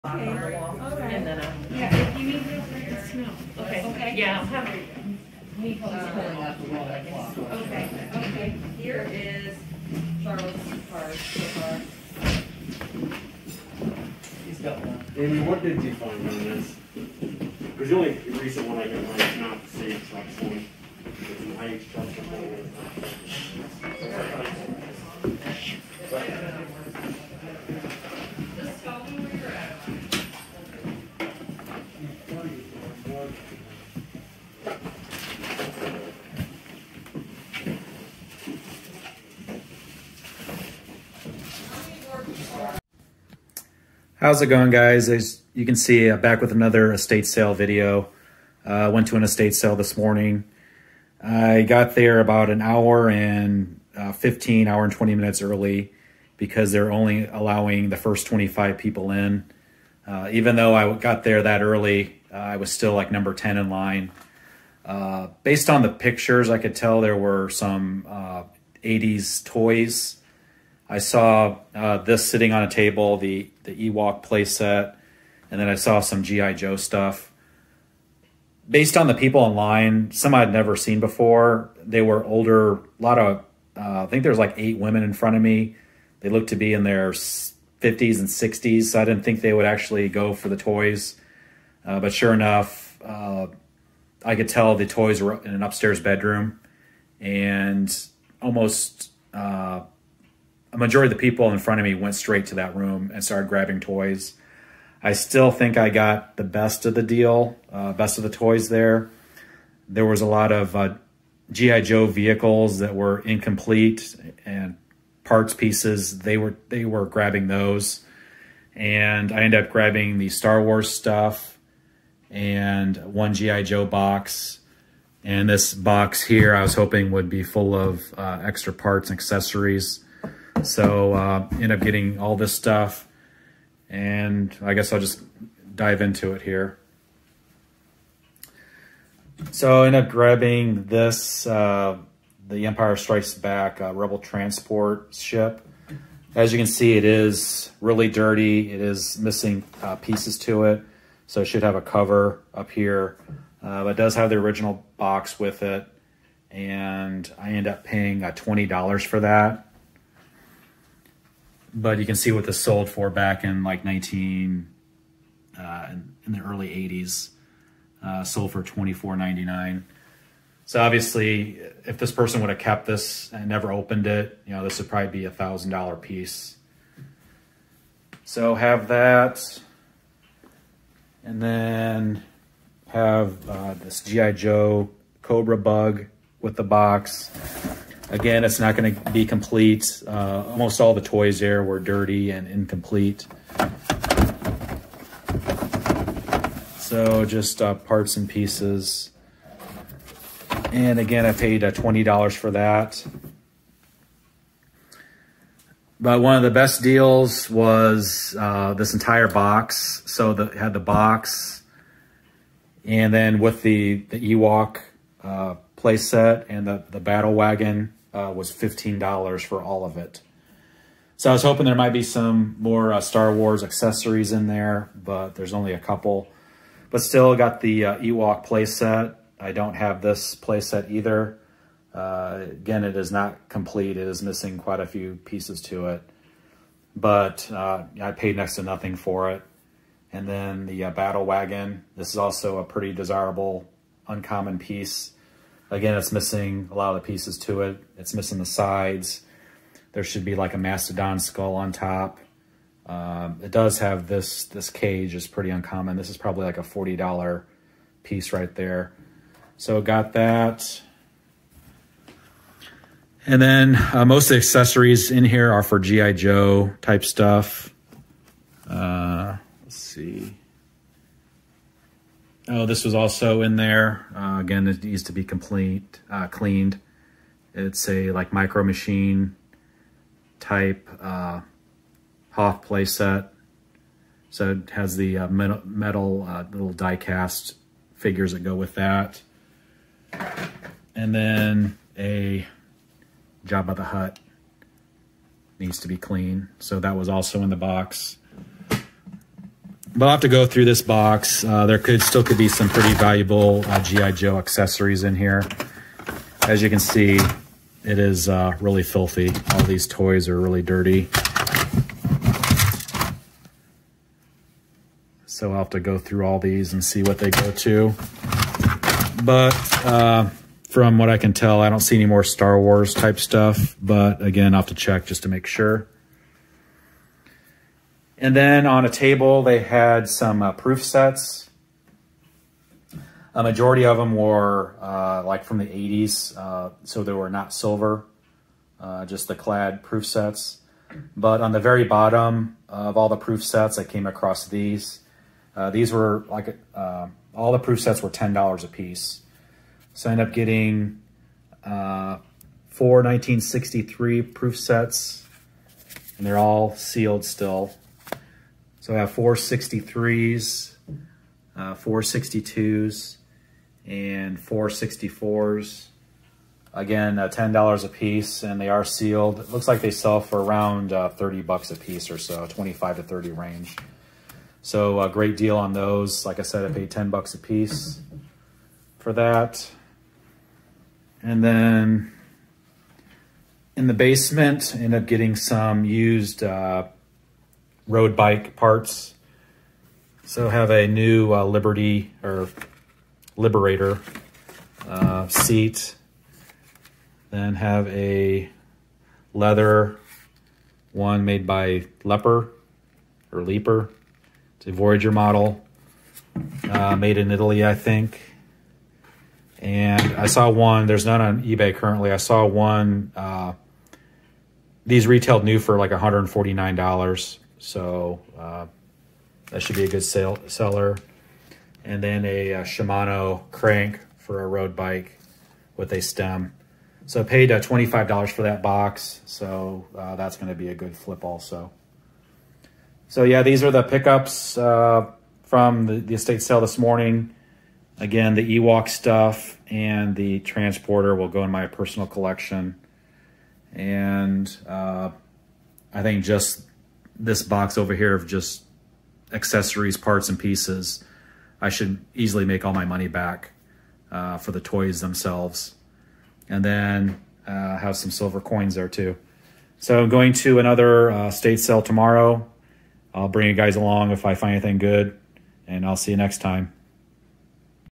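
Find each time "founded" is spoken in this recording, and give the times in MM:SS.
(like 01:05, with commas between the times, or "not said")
not said.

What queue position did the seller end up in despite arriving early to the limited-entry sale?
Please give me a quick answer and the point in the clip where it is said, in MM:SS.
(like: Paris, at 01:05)
10, at 01:03.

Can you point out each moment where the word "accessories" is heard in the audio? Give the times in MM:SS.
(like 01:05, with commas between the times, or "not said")
02:09, 03:43, 04:24, 05:04, 07:29.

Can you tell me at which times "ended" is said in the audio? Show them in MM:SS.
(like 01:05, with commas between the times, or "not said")
01:59, 05:50.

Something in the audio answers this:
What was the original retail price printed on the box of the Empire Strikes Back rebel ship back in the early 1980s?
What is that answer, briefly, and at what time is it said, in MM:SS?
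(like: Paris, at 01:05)
$24.99, at 02:48.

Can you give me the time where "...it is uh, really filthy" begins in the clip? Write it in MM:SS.
05:07.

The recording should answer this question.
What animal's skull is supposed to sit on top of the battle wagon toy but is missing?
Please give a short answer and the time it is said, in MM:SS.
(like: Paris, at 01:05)
mastodon, at 04:10.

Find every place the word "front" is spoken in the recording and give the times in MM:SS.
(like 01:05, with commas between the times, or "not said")
01:25, 01:41.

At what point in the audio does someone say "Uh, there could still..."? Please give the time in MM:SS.
05:01.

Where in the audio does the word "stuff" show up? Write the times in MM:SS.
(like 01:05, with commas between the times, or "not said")
01:16, 02:00, 02:12, 04:27, 05:23, 07:18.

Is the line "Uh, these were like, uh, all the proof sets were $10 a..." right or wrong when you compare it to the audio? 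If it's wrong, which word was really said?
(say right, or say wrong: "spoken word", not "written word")
right.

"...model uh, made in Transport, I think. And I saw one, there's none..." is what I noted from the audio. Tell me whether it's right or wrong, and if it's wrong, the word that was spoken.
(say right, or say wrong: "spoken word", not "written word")
wrong: "Italy", not "Transport".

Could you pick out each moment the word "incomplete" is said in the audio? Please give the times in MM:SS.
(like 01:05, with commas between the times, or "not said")
01:53, 03:12.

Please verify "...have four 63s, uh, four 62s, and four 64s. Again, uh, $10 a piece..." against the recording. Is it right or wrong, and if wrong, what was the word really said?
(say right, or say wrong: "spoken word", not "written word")
right.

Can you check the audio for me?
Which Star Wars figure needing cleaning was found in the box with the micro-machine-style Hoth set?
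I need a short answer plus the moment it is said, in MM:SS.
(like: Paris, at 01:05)
Jabba the Hutt, at 04:53.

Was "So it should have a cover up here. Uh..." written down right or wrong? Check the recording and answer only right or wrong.
right.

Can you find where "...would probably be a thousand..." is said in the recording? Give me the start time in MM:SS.
02:54.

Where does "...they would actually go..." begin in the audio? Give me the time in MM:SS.
01:29.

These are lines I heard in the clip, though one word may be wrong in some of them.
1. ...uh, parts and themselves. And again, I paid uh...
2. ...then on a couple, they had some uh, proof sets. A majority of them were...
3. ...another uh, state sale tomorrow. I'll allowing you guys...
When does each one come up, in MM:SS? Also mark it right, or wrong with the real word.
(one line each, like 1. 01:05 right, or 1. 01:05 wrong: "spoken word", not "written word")
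1. 03:17 wrong: "pieces", not "themselves"
2. 05:28 wrong: "table", not "couple"
3. 07:40 wrong: "bring", not "allowing".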